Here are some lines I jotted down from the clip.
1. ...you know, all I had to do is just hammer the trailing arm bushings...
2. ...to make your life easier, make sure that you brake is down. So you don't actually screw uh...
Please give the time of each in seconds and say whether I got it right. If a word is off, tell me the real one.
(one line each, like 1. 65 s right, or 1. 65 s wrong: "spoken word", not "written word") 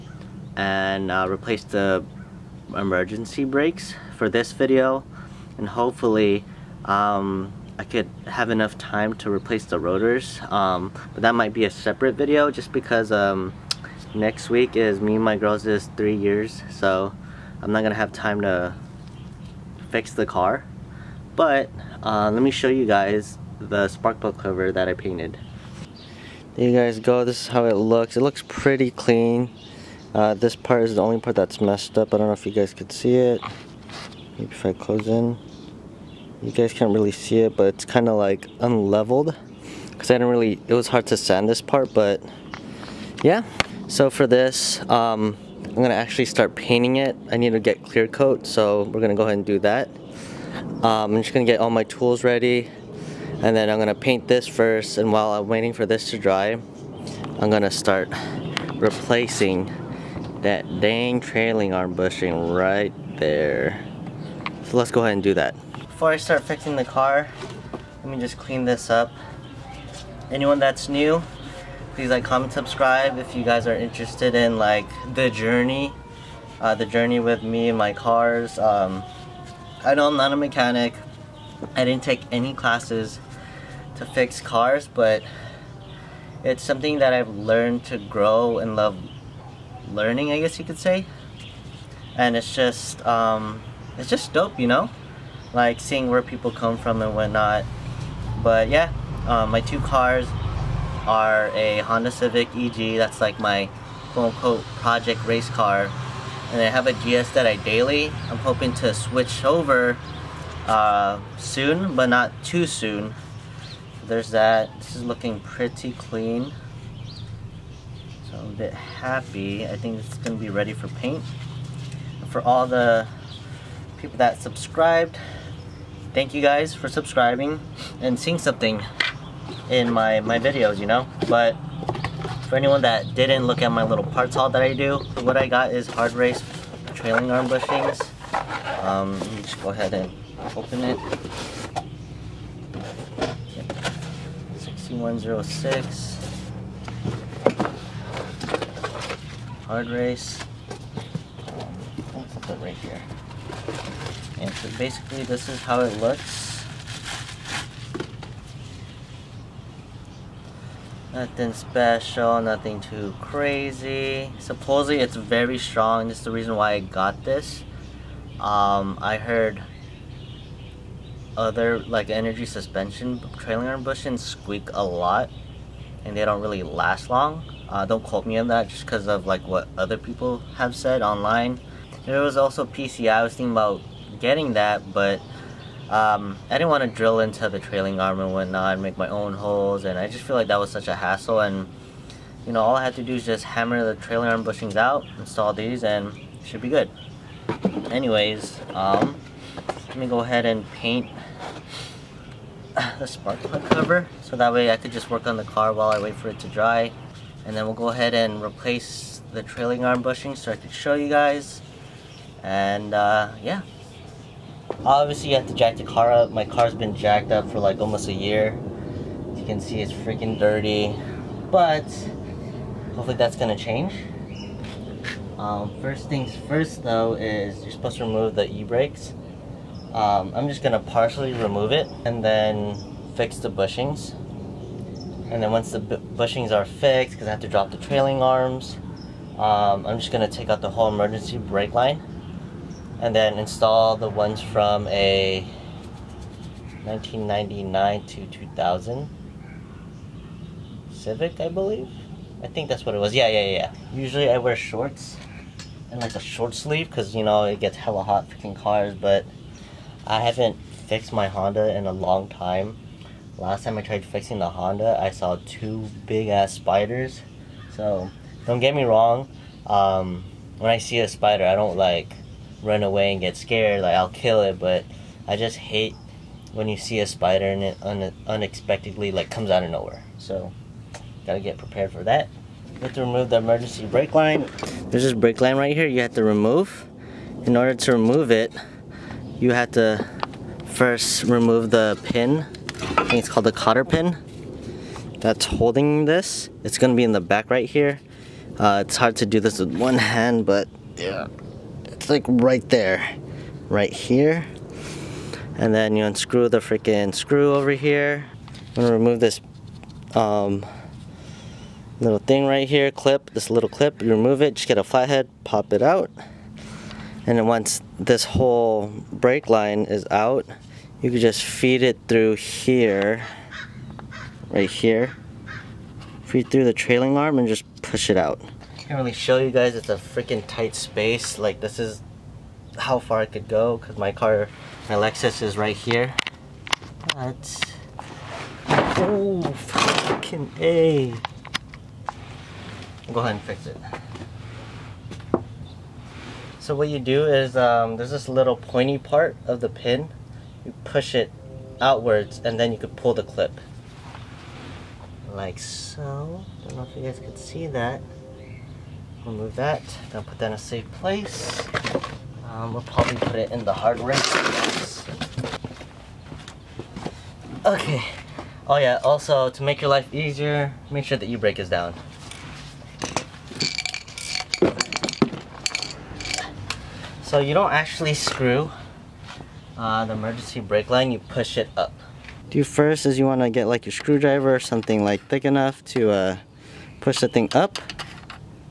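1. 192 s right
2. 369 s right.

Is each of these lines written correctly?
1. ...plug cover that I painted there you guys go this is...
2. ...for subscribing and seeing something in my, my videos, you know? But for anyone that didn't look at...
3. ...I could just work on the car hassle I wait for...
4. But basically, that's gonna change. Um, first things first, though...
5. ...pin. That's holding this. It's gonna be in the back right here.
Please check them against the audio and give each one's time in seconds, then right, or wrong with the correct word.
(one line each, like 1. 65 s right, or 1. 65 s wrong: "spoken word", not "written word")
1. 24 s right
2. 126 s right
3. 204 s wrong: "while", not "hassle"
4. 221 s wrong: "hopefully", not "basically"
5. 293 s right.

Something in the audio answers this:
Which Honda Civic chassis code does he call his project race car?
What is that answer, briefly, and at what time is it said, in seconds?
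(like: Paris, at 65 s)
EG, at 102 s.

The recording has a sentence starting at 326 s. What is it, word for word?
Feed through the trailing arm and just push it out can really show you guys.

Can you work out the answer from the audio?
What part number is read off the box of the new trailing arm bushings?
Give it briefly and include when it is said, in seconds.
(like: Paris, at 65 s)
6106, at 144 s.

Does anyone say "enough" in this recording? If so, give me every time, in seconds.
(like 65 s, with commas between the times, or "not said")
8 s, 385 s.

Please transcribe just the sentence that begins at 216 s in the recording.
My car's been jacked up for like almost a year.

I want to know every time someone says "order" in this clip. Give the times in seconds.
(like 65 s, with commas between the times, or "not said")
287 s.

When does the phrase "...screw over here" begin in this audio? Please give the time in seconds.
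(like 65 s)
307 s.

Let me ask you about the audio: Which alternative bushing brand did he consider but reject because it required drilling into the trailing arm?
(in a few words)
PCI.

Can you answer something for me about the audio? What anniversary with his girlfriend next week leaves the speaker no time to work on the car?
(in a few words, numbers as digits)
3 years.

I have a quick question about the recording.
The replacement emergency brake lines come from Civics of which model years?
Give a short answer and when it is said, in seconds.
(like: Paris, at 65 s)
1999 to 2000, at 246 s.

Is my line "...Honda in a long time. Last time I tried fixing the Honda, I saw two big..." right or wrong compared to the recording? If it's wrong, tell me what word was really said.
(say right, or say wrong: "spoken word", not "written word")
right.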